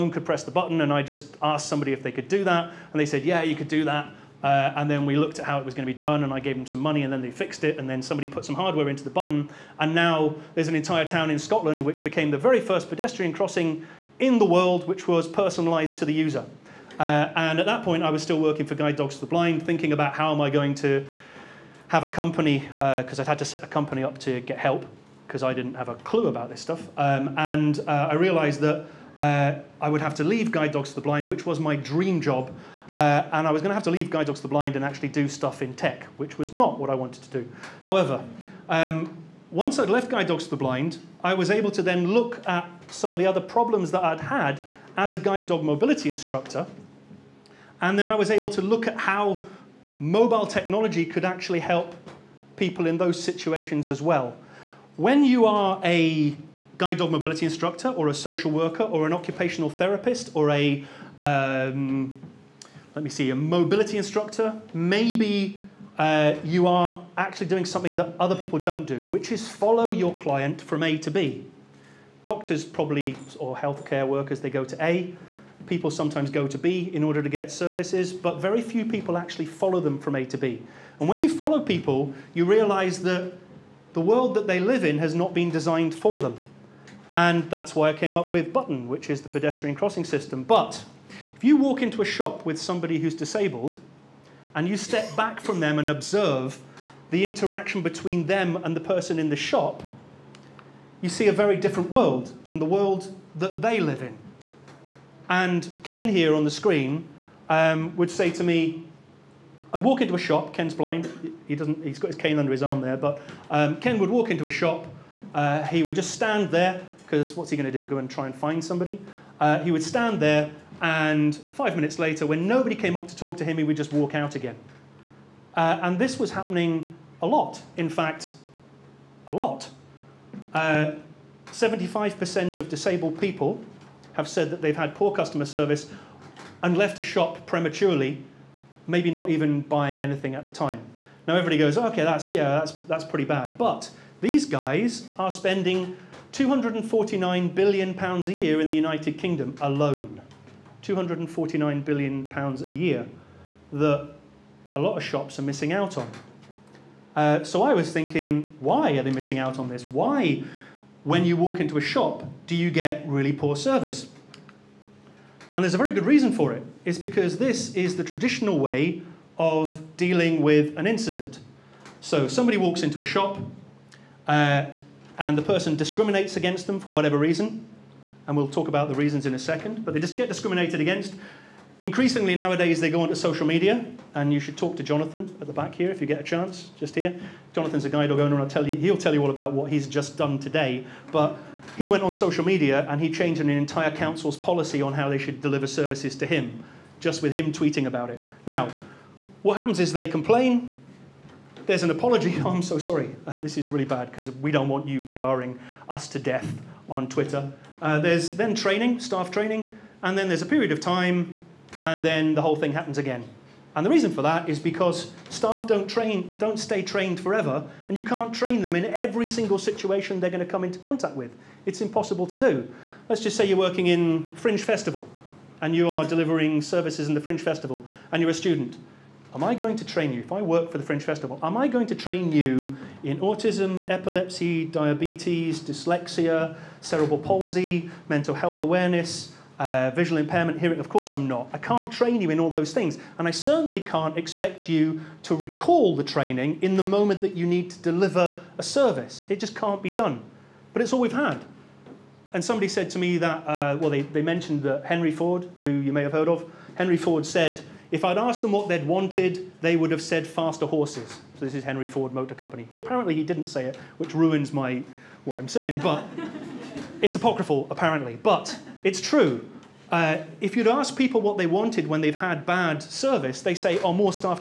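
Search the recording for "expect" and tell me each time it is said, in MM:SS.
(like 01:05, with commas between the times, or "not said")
04:04.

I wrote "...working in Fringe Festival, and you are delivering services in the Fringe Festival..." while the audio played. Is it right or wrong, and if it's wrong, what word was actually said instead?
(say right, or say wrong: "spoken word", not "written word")
right.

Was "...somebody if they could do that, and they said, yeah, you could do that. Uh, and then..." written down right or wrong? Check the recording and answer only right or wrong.
right.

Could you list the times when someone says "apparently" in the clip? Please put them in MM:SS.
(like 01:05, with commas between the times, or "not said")
04:22, 04:27.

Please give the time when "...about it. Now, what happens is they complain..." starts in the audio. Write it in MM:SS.
03:17.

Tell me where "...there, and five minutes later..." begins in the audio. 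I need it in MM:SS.
02:00.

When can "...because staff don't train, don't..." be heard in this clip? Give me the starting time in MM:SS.
03:34.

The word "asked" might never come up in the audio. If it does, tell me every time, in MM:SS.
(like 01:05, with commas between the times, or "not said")
00:01, 04:18.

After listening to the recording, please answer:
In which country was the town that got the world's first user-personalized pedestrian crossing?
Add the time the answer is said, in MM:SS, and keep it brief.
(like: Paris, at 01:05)
Scotland, at 00:11.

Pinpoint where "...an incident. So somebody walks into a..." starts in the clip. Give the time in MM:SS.
02:50.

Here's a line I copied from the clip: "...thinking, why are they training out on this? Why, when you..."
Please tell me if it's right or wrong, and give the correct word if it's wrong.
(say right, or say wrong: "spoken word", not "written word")
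wrong: "missing", not "training".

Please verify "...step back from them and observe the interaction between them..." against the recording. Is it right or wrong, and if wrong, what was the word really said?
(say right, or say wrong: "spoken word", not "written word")
right.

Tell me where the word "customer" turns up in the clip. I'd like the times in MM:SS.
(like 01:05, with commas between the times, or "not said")
02:15.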